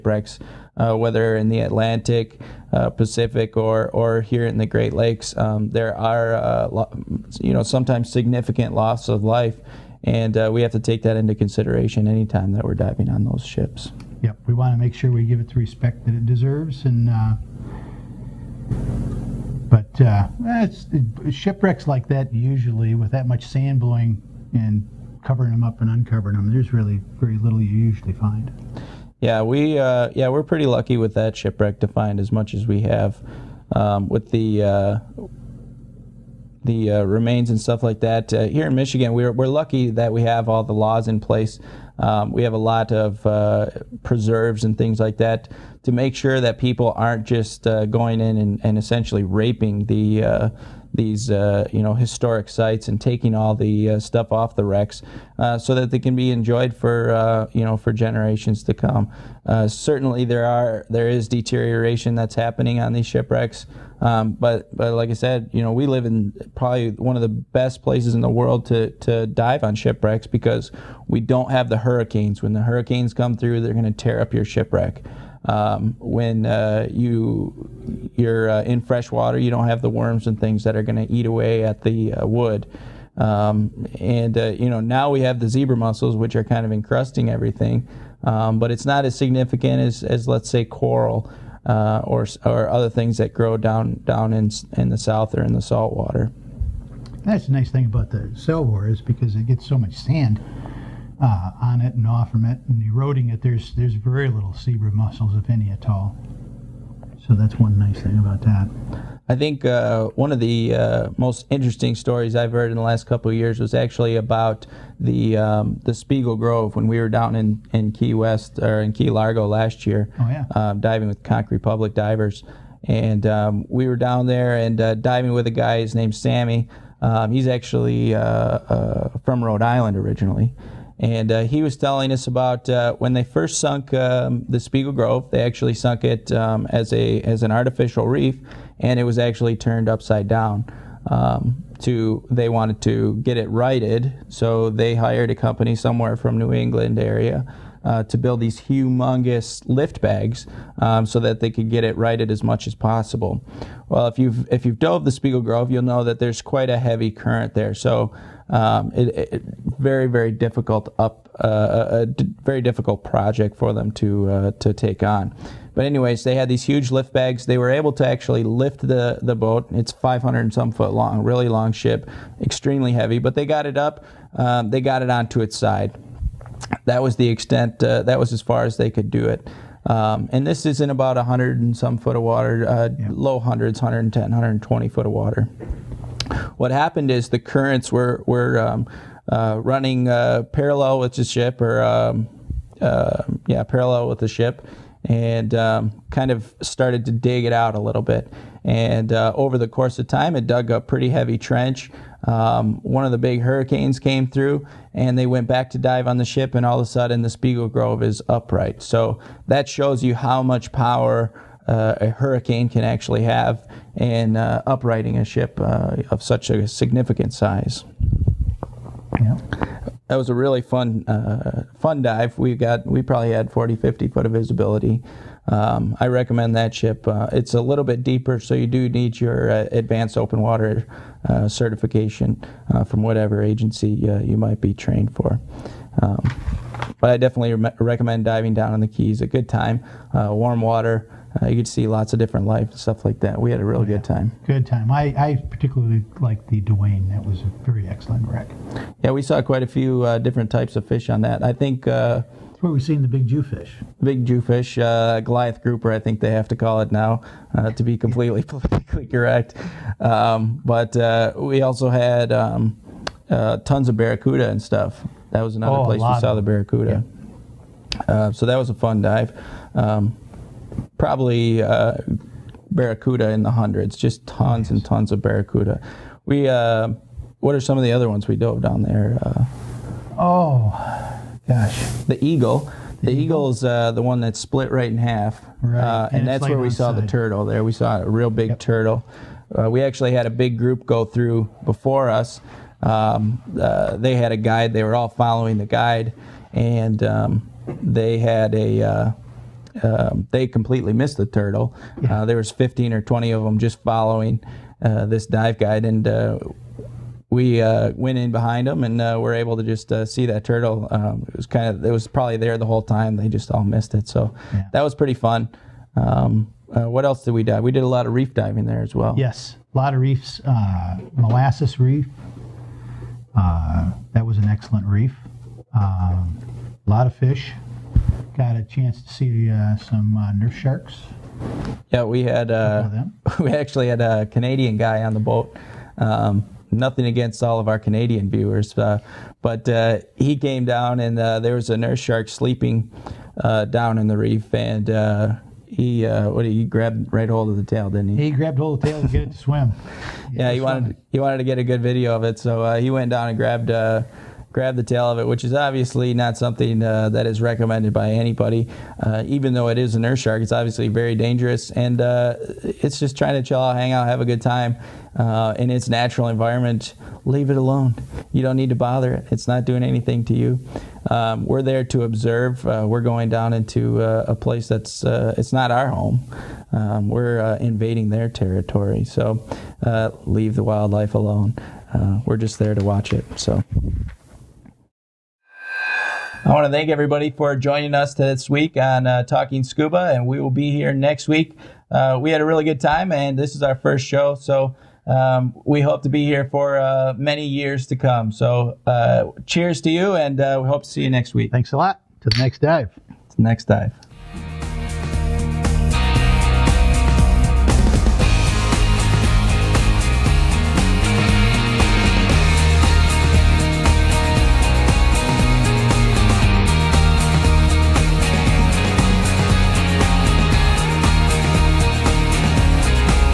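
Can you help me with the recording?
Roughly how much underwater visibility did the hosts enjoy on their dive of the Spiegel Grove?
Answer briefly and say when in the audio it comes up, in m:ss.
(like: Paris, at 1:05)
40-50 feet, at 3:43.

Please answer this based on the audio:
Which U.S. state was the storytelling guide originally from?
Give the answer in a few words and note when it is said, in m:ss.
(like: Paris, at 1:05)
Rhode Island, at 2:09.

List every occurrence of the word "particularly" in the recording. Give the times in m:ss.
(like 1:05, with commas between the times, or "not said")
4:05.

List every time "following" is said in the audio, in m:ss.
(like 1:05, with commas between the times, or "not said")
4:55, 5:03.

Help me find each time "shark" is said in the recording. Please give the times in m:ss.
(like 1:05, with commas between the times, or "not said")
5:30, 5:41, 6:00.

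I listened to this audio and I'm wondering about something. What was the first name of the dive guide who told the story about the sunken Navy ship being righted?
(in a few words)
Sammy.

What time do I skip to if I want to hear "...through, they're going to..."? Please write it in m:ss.
1:13.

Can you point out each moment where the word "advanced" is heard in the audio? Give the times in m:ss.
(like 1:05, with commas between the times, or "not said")
3:49.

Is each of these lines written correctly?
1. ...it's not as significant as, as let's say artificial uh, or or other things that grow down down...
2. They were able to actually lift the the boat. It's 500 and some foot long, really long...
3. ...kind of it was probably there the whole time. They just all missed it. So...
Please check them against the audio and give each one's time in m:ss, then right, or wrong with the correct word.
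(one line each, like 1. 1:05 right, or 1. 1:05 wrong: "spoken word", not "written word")
1. 1:28 wrong: "coral", not "artificial"
2. 2:47 right
3. 5:11 right.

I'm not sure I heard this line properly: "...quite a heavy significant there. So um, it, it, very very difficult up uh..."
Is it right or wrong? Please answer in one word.
wrong.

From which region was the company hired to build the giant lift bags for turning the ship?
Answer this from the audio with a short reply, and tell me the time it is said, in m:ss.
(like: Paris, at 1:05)
New England, at 2:26.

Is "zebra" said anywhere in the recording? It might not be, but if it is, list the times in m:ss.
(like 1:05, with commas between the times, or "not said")
1:25, 1:44.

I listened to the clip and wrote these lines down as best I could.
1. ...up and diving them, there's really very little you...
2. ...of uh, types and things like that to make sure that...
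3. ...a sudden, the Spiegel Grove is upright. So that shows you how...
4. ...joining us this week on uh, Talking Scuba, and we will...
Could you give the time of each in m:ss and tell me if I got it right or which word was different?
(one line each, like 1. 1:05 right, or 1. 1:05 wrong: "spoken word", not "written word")
1. 0:25 wrong: "uncovering", not "diving"
2. 0:42 wrong: "preserves", not "types"
3. 3:26 right
4. 6:27 right.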